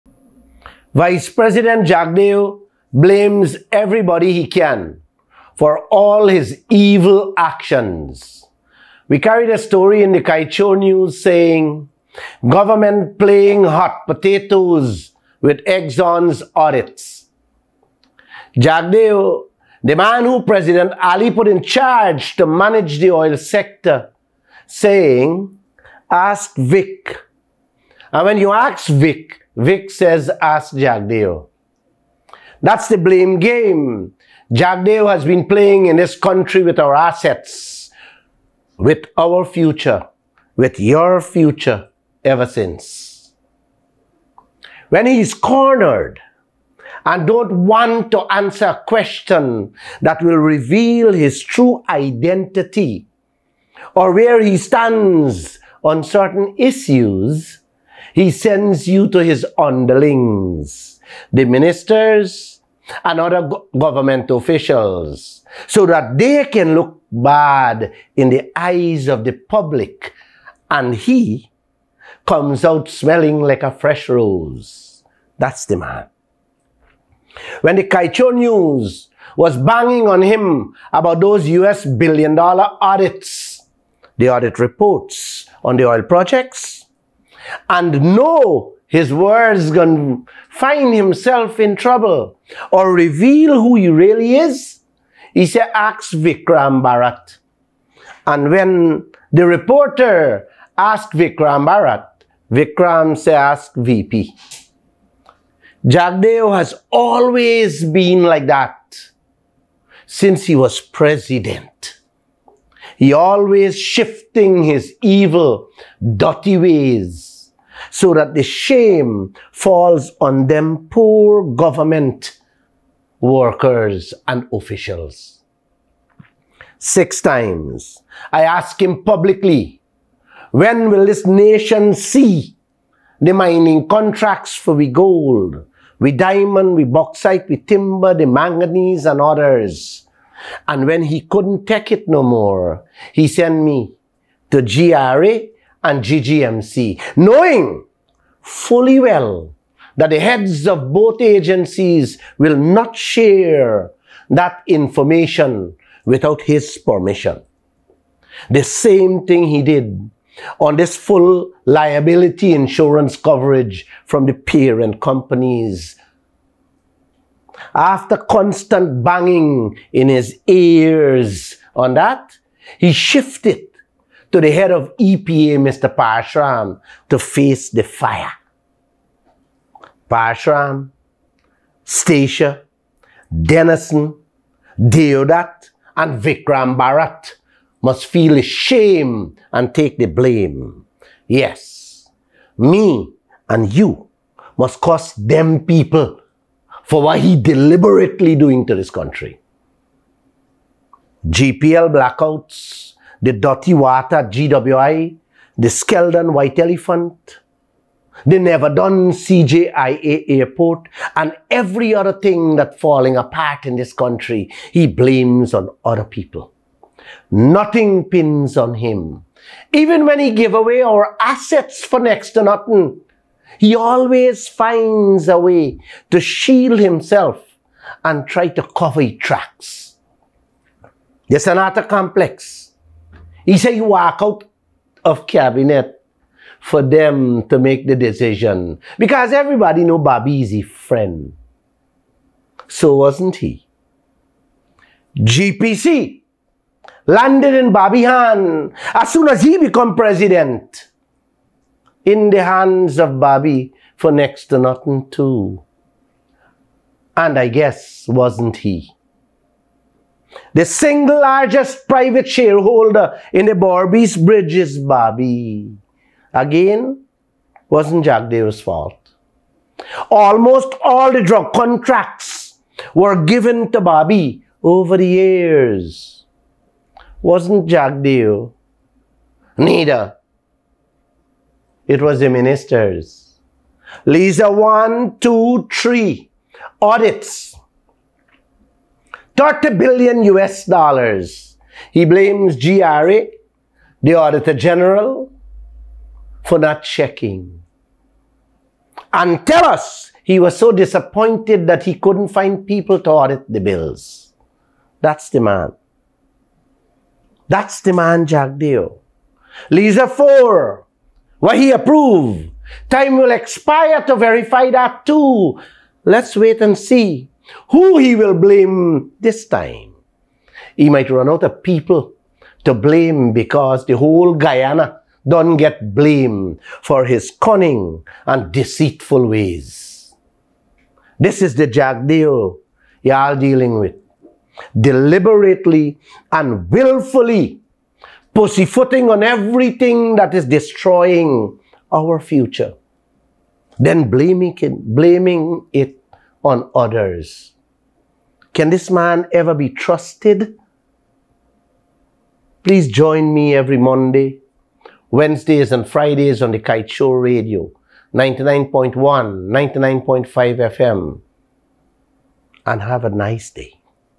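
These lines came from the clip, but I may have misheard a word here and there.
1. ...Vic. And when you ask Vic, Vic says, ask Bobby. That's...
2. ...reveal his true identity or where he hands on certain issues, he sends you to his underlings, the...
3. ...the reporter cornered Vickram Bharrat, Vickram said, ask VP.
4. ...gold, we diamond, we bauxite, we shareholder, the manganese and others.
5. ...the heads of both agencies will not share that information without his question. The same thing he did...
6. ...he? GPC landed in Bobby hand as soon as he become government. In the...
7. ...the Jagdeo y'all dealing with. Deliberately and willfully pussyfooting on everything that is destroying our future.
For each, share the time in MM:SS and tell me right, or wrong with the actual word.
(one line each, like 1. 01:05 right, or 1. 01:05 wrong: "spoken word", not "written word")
1. 00:26 wrong: "Jagdeo", not "Bobby"
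2. 00:50 wrong: "stands", not "hands"
3. 01:39 wrong: "asked", not "cornered"
4. 02:14 wrong: "timber", not "shareholder"
5. 02:30 wrong: "permission", not "question"
6. 04:03 wrong: "president", not "government"
7. 05:31 right.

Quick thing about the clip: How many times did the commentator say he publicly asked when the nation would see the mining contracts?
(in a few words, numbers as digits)
6.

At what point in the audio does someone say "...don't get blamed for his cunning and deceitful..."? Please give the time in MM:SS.
05:25.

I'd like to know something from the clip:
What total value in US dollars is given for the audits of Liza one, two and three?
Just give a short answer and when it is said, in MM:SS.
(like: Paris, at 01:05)
30 billion US dollars, at 04:49.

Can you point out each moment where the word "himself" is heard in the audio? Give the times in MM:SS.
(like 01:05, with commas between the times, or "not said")
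01:30, 03:46.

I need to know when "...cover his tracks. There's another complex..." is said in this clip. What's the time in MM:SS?
03:48.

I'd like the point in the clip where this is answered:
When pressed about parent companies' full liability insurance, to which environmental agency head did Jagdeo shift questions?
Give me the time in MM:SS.
02:55.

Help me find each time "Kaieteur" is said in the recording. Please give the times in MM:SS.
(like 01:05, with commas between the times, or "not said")
00:10, 01:17, 05:56.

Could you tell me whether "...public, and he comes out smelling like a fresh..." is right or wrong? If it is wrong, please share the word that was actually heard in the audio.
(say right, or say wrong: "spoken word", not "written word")
right.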